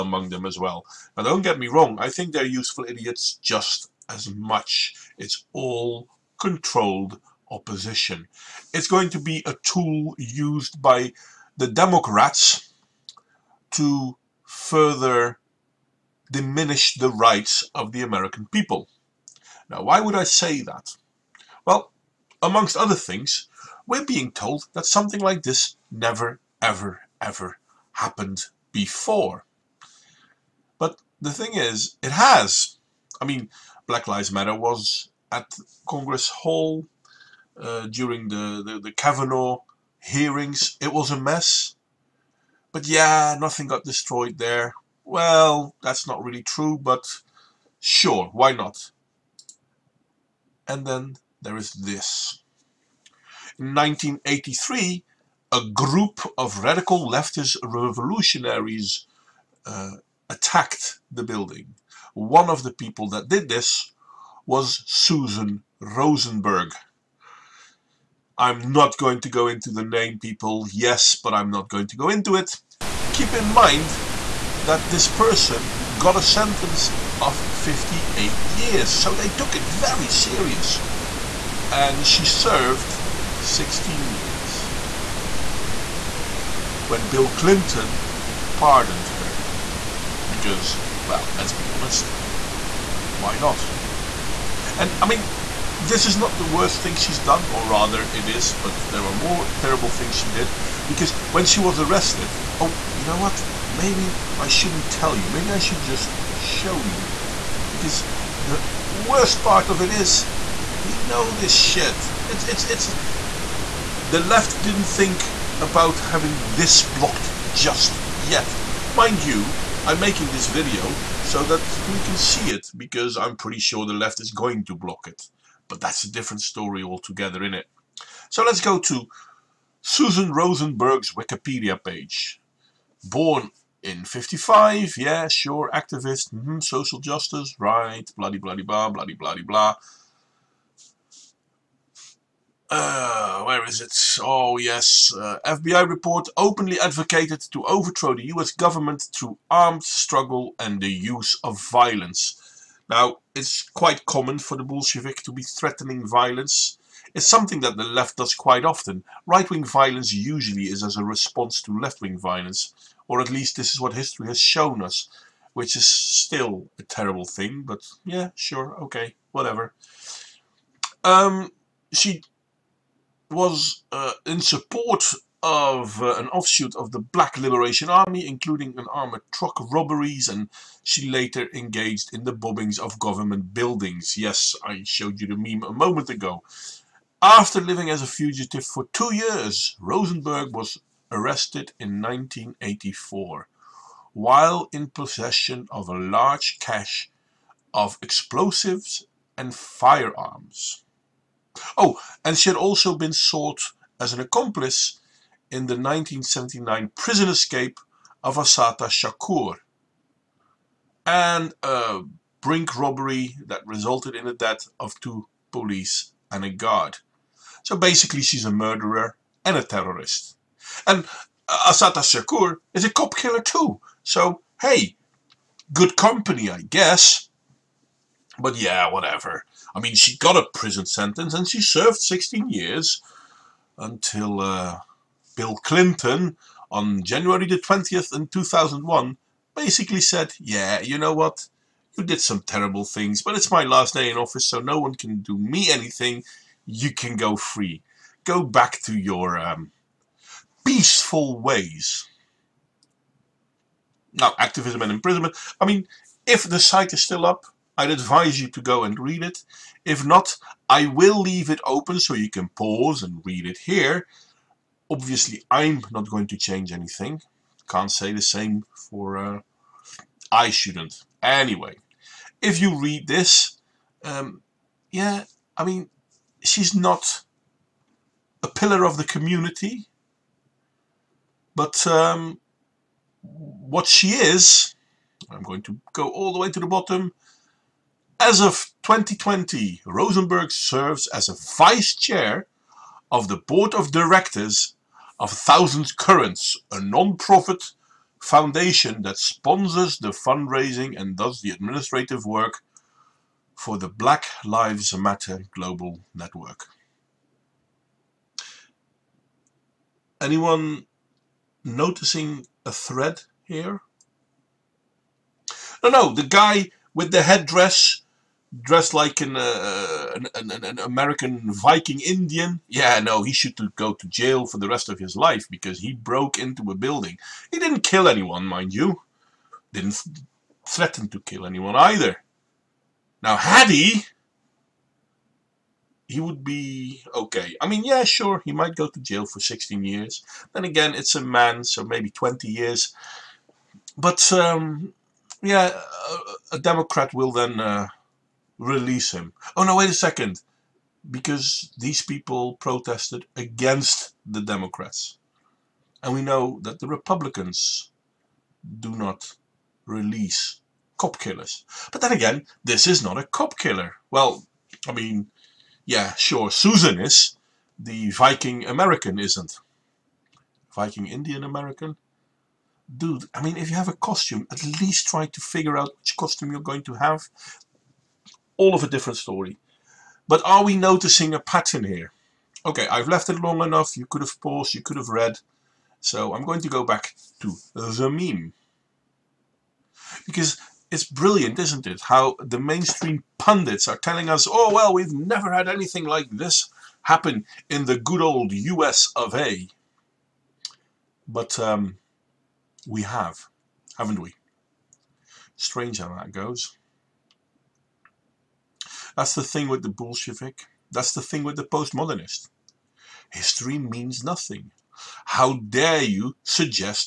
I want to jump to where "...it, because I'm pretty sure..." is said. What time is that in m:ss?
2:02.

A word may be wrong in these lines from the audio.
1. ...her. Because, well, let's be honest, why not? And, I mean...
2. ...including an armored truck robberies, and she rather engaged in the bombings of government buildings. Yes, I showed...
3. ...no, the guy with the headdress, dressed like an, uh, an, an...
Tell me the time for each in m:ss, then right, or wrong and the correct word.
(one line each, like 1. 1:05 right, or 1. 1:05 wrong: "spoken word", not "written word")
1. 1:29 right
2. 2:58 wrong: "later", not "rather"
3. 5:15 right.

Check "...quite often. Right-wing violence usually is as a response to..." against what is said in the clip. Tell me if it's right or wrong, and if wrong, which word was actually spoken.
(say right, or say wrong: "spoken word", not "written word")
right.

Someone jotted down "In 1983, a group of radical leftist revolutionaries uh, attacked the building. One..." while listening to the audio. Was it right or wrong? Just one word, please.
right.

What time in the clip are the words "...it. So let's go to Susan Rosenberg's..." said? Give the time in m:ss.
2:07.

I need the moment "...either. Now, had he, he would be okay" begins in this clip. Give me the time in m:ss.
5:31.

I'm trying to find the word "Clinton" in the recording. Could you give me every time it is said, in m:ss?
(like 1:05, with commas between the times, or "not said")
1:27, 3:55.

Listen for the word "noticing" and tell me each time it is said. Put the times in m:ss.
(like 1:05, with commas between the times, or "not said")
5:11, 6:20.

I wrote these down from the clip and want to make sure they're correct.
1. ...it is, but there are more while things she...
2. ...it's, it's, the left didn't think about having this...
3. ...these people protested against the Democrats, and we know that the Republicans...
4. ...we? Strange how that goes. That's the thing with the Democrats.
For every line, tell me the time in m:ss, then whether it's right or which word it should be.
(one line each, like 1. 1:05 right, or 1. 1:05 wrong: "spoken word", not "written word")
1. 1:38 wrong: "terrible", not "while"
2. 1:52 right
3. 5:51 right
4. 6:44 wrong: "Bolshevik", not "Democrats".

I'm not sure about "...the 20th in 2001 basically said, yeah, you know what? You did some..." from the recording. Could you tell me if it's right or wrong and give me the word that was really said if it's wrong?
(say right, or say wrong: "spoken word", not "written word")
right.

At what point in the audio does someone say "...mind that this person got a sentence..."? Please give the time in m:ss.
1:13.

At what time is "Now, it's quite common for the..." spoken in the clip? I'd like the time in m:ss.
2:32.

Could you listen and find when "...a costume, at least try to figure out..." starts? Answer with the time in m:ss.
6:13.